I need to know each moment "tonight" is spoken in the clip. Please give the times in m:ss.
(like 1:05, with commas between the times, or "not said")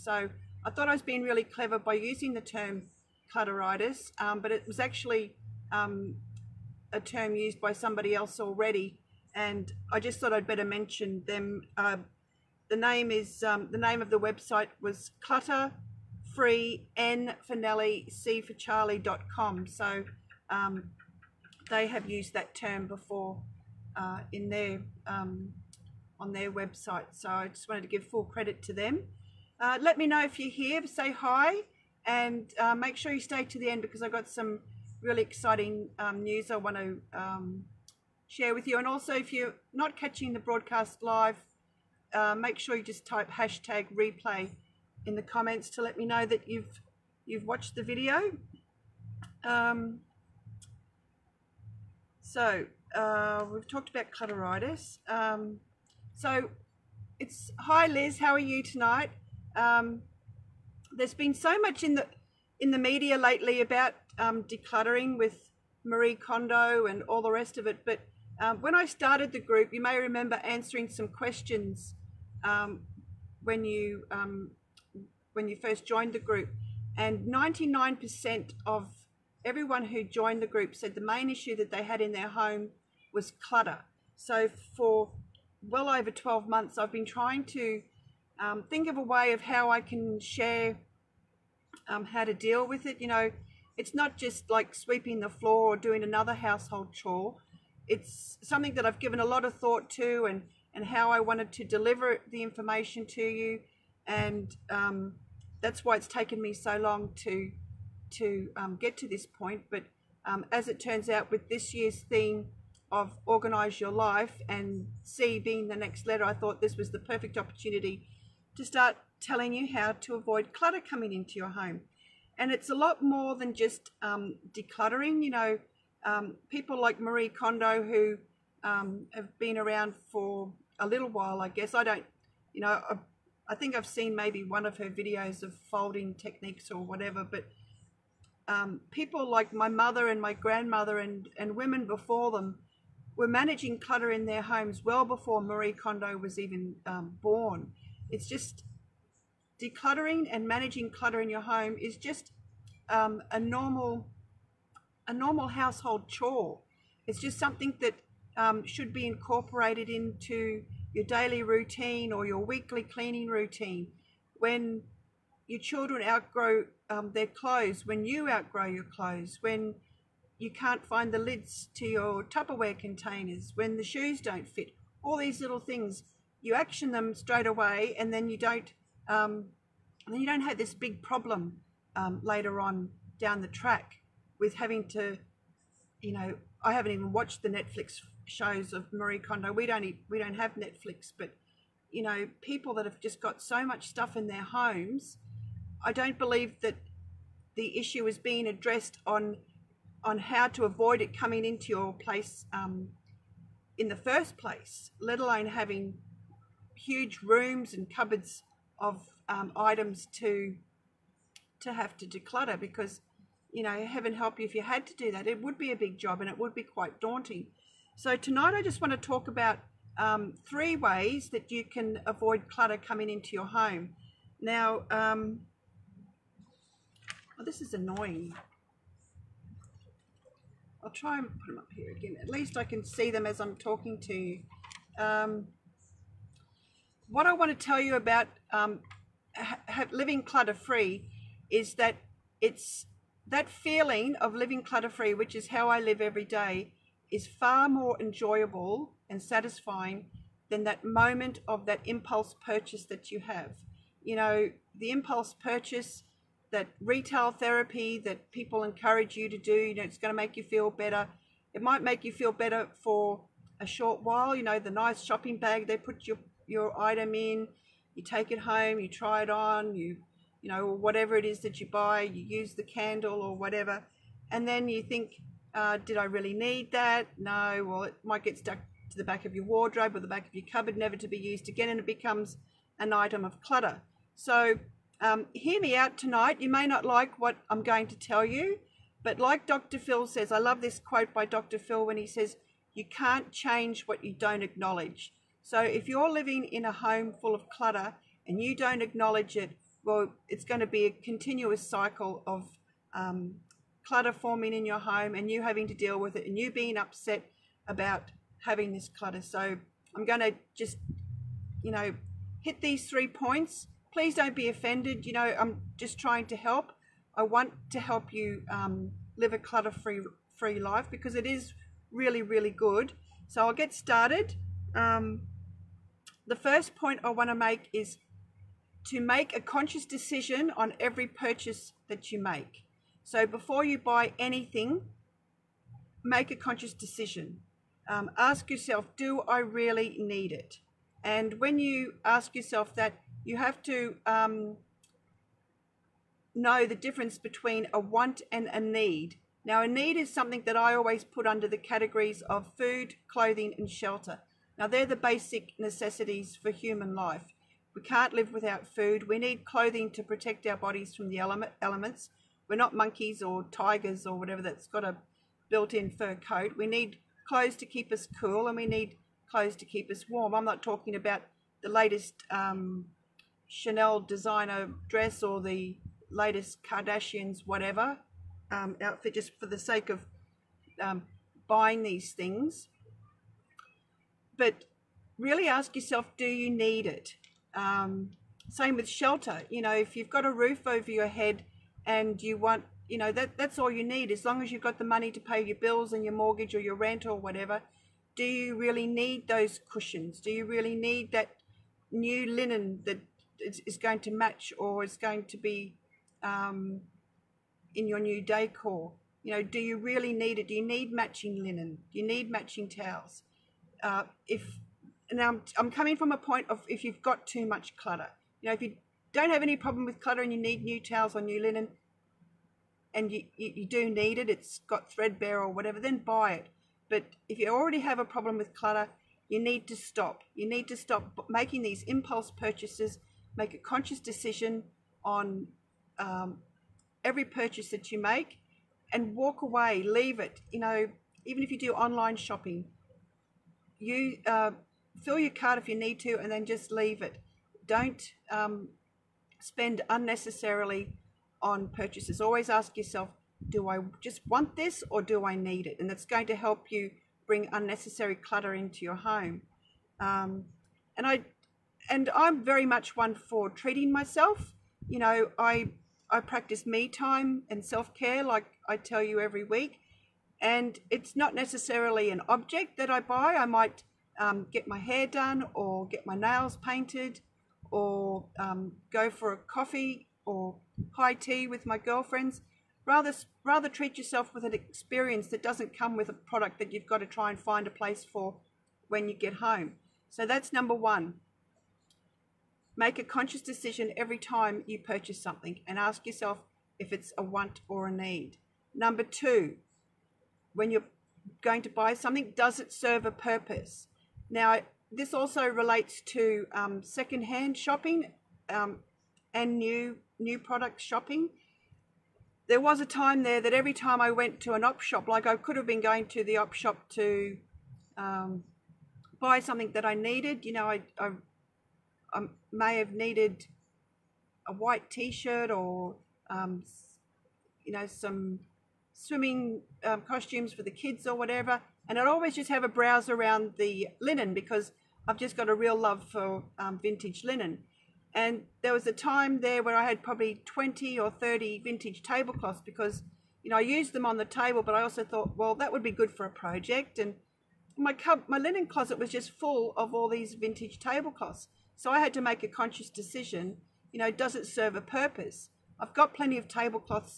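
0:58, 3:38, 4:45.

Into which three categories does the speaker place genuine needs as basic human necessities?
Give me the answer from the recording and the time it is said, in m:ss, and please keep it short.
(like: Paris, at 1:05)
Food, clothing, and shelter, at 5:52.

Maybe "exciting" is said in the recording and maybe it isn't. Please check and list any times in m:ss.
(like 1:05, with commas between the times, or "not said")
0:35.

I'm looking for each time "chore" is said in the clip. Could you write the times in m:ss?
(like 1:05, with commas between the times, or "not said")
1:36, 2:36.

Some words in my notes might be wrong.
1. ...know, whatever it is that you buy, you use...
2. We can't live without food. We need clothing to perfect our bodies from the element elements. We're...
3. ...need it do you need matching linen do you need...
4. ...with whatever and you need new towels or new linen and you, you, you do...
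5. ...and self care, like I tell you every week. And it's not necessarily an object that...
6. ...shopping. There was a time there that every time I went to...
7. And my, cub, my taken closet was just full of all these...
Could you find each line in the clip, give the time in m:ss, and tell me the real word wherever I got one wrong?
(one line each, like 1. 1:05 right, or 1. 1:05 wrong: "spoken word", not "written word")
1. 4:30 right
2. 5:57 wrong: "protect", not "perfect"
3. 6:50 right
4. 6:59 wrong: "clutter", not "whatever"
5. 7:47 right
6. 8:30 right
7. 9:06 wrong: "linen", not "taken".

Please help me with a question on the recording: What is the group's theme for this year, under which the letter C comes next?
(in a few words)
Organise Your Life.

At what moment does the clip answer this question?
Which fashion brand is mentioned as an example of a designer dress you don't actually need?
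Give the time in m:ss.
6:13.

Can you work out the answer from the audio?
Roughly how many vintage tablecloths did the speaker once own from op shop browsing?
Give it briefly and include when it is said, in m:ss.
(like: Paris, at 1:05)
20 or 30, at 9:00.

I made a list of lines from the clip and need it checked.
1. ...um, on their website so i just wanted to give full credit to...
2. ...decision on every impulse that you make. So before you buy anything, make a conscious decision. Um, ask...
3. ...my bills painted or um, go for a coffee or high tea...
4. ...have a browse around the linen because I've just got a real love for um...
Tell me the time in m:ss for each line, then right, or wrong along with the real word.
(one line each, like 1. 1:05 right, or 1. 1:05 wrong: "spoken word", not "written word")
1. 0:25 right
2. 5:29 wrong: "purchase", not "impulse"
3. 7:56 wrong: "nails", not "bills"
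4. 8:52 right.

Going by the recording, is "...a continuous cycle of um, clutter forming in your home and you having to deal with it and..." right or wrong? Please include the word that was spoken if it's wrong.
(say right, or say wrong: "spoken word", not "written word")
right.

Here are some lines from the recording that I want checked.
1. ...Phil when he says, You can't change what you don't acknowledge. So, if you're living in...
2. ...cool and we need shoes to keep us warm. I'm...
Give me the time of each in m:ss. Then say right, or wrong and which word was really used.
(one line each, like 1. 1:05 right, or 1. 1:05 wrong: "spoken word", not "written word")
1. 4:51 right
2. 6:08 wrong: "clothes", not "shoes".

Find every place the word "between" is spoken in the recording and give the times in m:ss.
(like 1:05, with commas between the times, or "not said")
5:47.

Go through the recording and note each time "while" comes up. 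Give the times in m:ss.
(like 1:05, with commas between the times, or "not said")
2:11, 4:24.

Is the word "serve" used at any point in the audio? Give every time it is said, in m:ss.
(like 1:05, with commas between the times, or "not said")
8:22, 9:14.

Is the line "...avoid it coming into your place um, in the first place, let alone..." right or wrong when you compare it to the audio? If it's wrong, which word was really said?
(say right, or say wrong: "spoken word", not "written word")
right.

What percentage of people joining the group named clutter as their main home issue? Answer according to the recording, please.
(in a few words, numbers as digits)
99%.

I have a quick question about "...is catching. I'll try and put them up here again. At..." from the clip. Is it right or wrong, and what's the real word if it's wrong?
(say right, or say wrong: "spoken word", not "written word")
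wrong: "annoying", not "catching".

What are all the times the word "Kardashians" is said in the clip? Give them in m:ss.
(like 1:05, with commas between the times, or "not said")
6:16.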